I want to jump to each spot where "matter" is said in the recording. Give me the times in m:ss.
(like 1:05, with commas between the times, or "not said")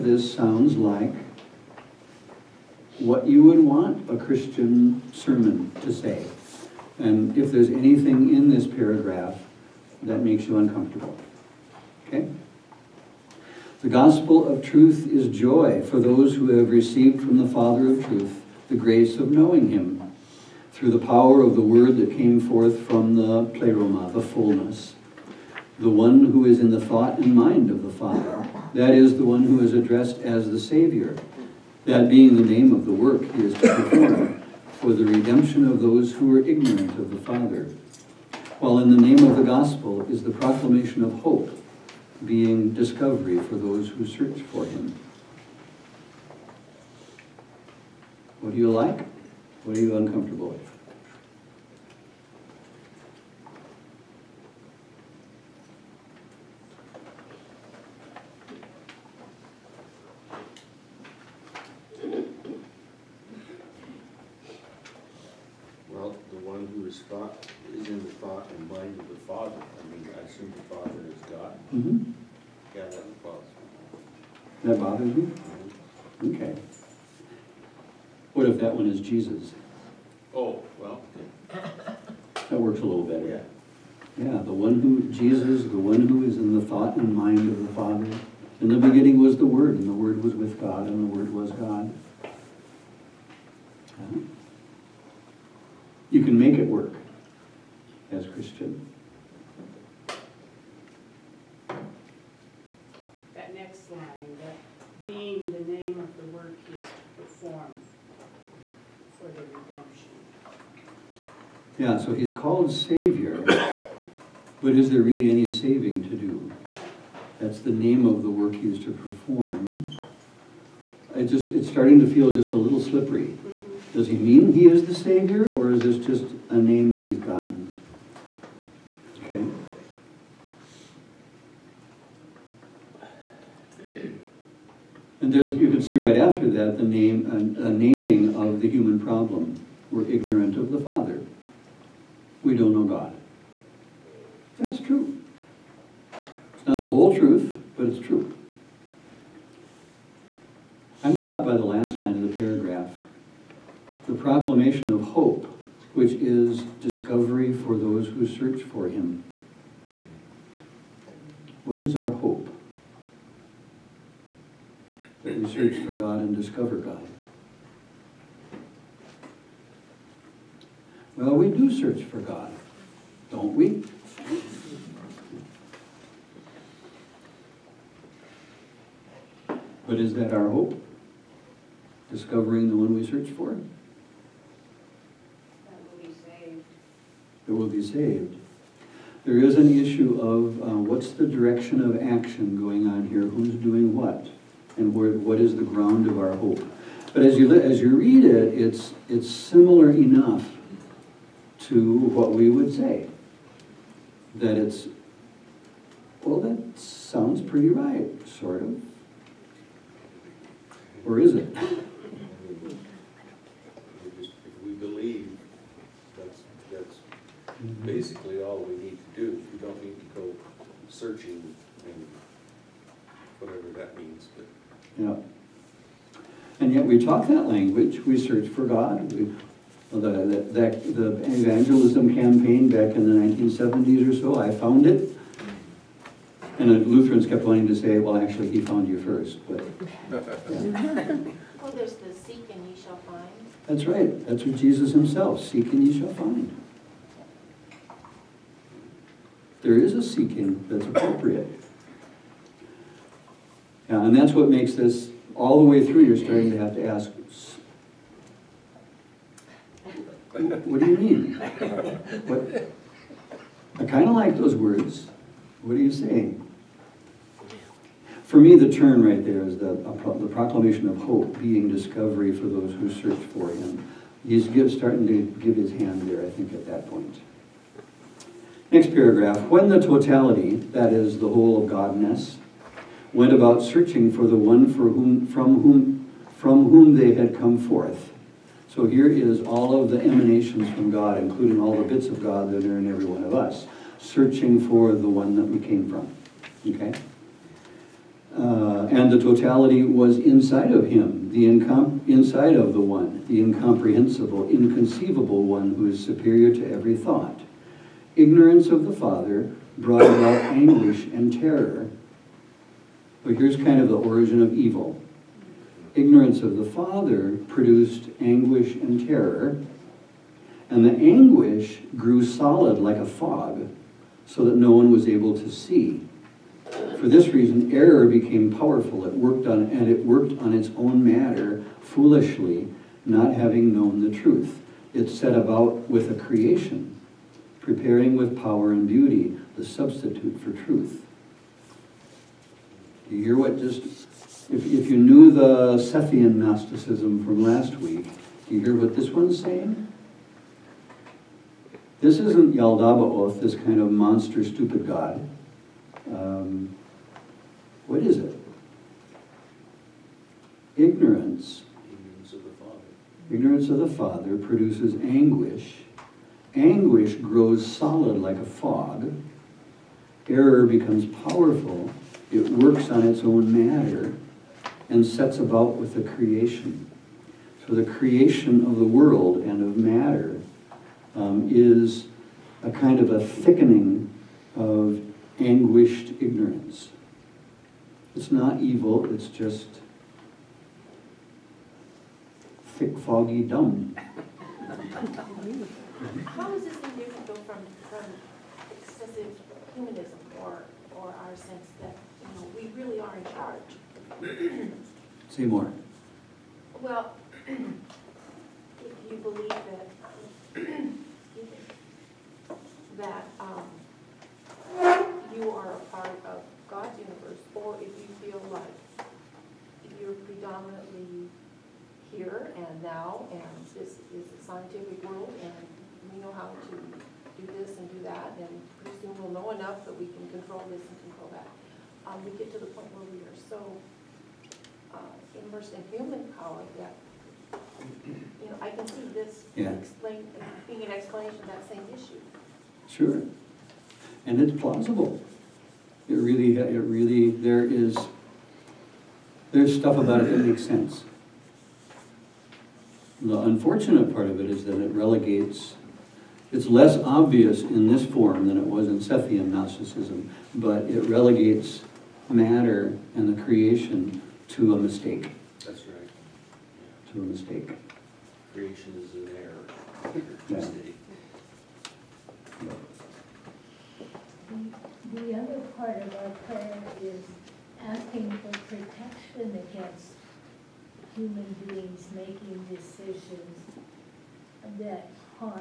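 5:31, 6:13, 6:19, 7:42.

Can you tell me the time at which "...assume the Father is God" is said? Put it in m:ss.
1:10.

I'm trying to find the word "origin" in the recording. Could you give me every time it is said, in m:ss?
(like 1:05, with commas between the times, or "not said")
5:13.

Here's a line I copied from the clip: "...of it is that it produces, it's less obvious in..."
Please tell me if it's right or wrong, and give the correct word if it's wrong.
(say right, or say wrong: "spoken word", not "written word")
wrong: "relegates", not "produces".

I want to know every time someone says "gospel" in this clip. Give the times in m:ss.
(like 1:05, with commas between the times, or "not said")
0:13, 0:39.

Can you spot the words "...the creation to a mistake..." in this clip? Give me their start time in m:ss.
7:43.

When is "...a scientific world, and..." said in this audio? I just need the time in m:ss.
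7:04.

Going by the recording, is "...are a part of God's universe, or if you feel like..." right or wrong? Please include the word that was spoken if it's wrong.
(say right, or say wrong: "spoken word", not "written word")
right.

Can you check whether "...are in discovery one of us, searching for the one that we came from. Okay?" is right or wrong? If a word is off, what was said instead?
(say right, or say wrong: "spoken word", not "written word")
wrong: "every", not "discovery".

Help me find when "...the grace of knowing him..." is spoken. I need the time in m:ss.
0:18.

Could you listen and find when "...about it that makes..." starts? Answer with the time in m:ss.
7:29.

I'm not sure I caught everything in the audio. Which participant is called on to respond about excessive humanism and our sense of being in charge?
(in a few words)
Seymour.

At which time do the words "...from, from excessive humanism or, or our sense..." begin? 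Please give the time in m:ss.
6:37.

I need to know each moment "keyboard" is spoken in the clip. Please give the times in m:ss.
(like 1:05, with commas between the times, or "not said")
not said.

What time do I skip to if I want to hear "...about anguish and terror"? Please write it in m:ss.
5:10.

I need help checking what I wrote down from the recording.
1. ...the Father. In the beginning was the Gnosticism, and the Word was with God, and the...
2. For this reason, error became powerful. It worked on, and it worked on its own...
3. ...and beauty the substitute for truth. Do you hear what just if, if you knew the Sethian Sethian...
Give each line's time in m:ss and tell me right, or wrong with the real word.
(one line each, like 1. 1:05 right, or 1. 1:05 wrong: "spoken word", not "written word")
1. 1:27 wrong: "Word", not "Gnosticism"
2. 5:26 right
3. 5:38 wrong: "Gnosticism", not "Sethian".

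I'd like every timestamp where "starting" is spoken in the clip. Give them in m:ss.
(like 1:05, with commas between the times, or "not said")
2:01, 4:16, 4:34.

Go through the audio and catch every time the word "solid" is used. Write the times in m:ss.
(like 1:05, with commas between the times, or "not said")
5:22, 6:07.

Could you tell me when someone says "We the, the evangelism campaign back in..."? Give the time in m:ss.
3:49.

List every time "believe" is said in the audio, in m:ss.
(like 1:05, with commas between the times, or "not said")
3:34, 6:49.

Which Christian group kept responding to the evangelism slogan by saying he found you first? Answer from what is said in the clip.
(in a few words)
Lutherans.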